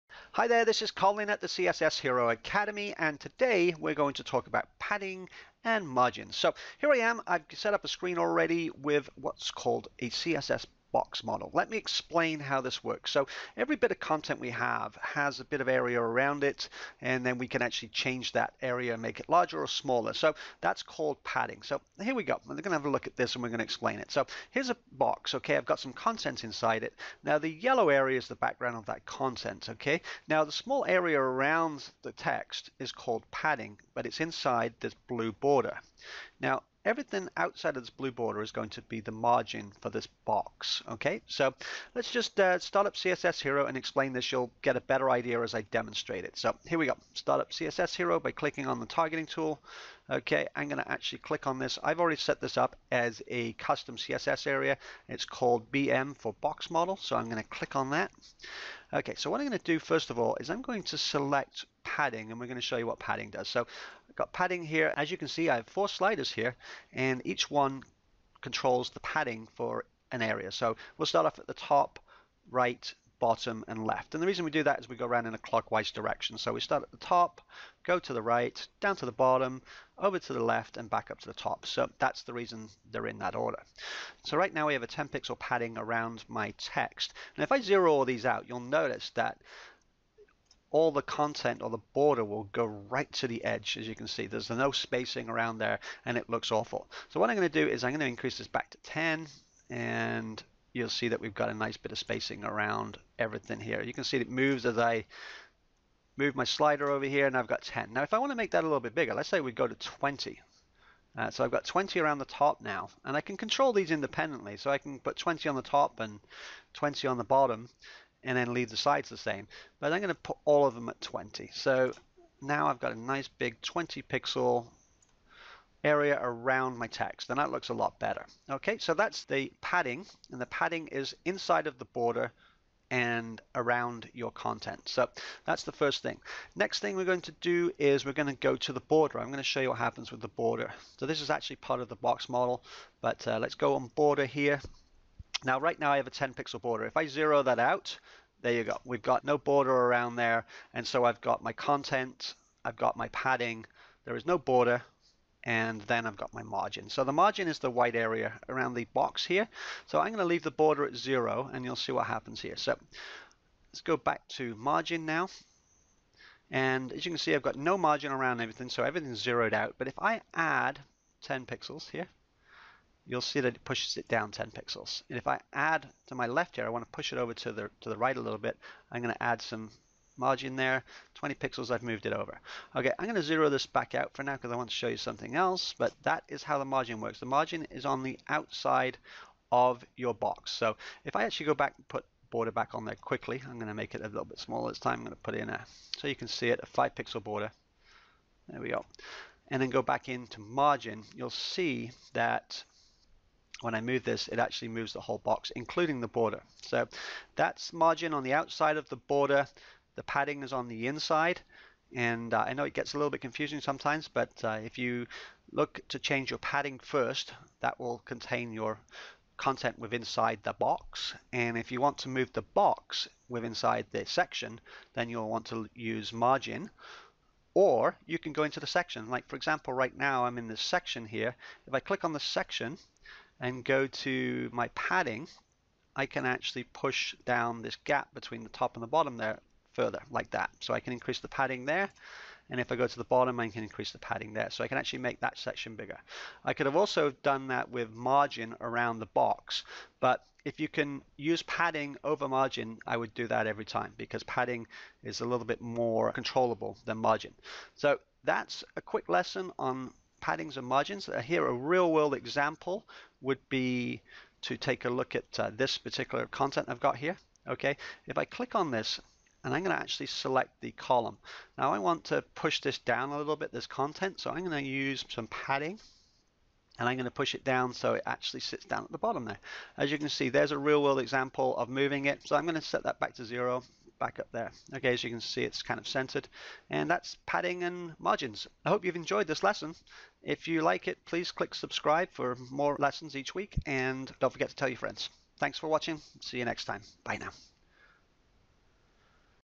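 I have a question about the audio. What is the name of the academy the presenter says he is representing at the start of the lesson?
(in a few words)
CSS Hero Academy.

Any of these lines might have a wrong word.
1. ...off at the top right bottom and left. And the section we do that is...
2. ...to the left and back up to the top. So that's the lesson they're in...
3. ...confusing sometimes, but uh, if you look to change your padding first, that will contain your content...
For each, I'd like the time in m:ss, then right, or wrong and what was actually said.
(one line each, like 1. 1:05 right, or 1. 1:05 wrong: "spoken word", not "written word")
1. 1:11 wrong: "reason", not "section"
2. 1:20 wrong: "reason", not "lesson"
3. 3:33 right.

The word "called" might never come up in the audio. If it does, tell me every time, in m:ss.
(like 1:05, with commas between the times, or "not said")
0:09, 0:20, 0:32, 0:55.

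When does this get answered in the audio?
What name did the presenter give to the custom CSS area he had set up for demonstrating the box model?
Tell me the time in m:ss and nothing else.
0:55.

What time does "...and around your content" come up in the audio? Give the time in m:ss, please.
2:12.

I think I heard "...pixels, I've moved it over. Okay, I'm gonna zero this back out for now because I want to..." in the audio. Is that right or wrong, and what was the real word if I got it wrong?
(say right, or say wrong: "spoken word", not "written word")
right.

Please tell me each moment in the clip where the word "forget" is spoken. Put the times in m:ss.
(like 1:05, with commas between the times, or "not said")
4:54.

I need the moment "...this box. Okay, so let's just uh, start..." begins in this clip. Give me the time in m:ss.
0:39.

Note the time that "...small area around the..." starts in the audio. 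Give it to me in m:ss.
0:30.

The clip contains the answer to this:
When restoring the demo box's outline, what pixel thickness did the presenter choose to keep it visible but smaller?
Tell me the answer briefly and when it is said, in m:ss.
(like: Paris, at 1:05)
5 pixels, at 3:16.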